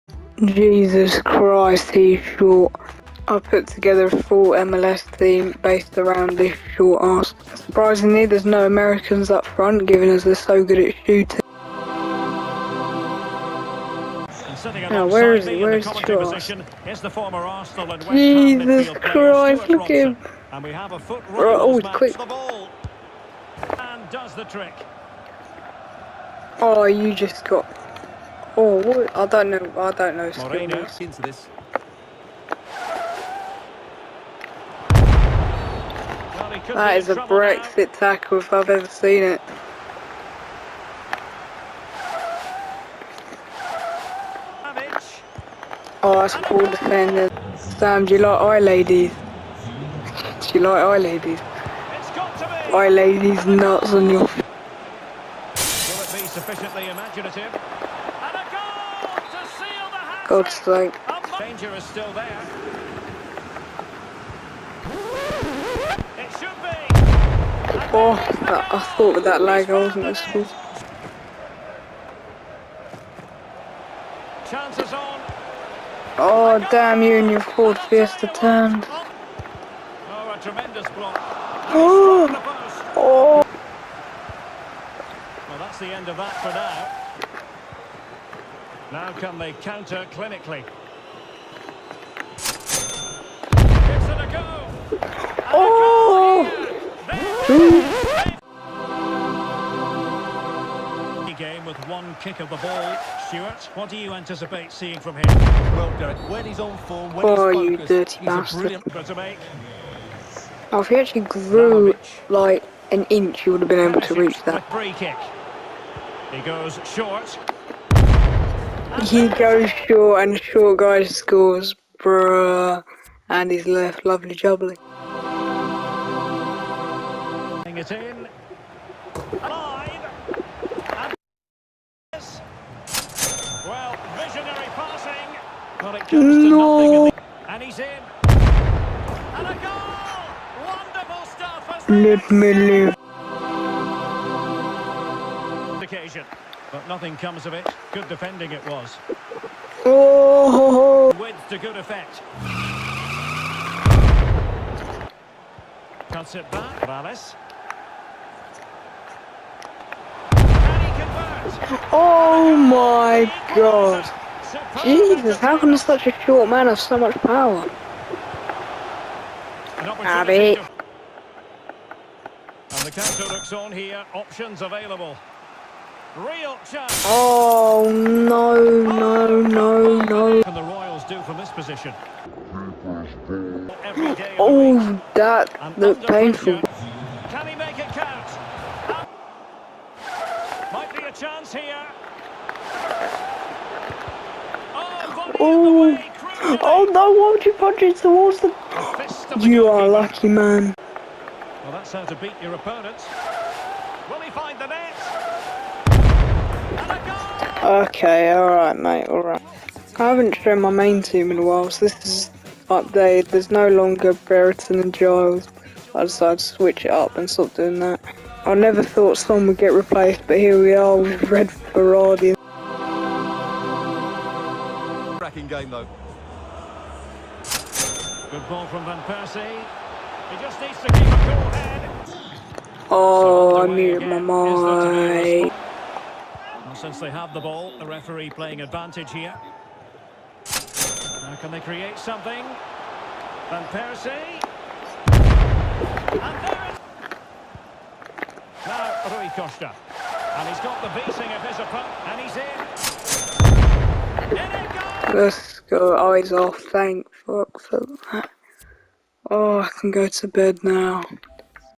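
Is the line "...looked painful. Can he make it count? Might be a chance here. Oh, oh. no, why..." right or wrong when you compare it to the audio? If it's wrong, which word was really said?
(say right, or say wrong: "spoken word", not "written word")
right.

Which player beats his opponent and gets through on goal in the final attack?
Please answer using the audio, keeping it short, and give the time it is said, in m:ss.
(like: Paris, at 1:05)
Rui Costa, at 4:09.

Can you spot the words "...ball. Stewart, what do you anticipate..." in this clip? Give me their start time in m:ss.
1:42.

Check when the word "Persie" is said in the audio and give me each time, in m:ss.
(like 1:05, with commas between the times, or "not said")
3:49, 4:03.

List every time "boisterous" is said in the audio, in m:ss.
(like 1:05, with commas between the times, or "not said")
not said.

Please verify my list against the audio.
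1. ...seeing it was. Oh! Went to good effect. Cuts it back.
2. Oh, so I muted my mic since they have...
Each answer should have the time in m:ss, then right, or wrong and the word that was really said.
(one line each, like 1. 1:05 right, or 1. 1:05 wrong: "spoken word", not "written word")
1. 2:28 wrong: "defending", not "seeing"
2. 3:52 right.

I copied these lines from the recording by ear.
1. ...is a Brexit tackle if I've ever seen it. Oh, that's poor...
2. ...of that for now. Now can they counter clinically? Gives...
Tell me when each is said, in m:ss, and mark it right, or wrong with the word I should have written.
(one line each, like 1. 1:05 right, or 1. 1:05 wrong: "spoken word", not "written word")
1. 0:36 right
2. 1:26 right.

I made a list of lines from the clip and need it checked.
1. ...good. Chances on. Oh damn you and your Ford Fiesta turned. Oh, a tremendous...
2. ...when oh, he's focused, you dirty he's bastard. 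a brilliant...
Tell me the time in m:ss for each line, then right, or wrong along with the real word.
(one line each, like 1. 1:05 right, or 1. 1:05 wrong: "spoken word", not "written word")
1. 1:10 right
2. 1:47 right.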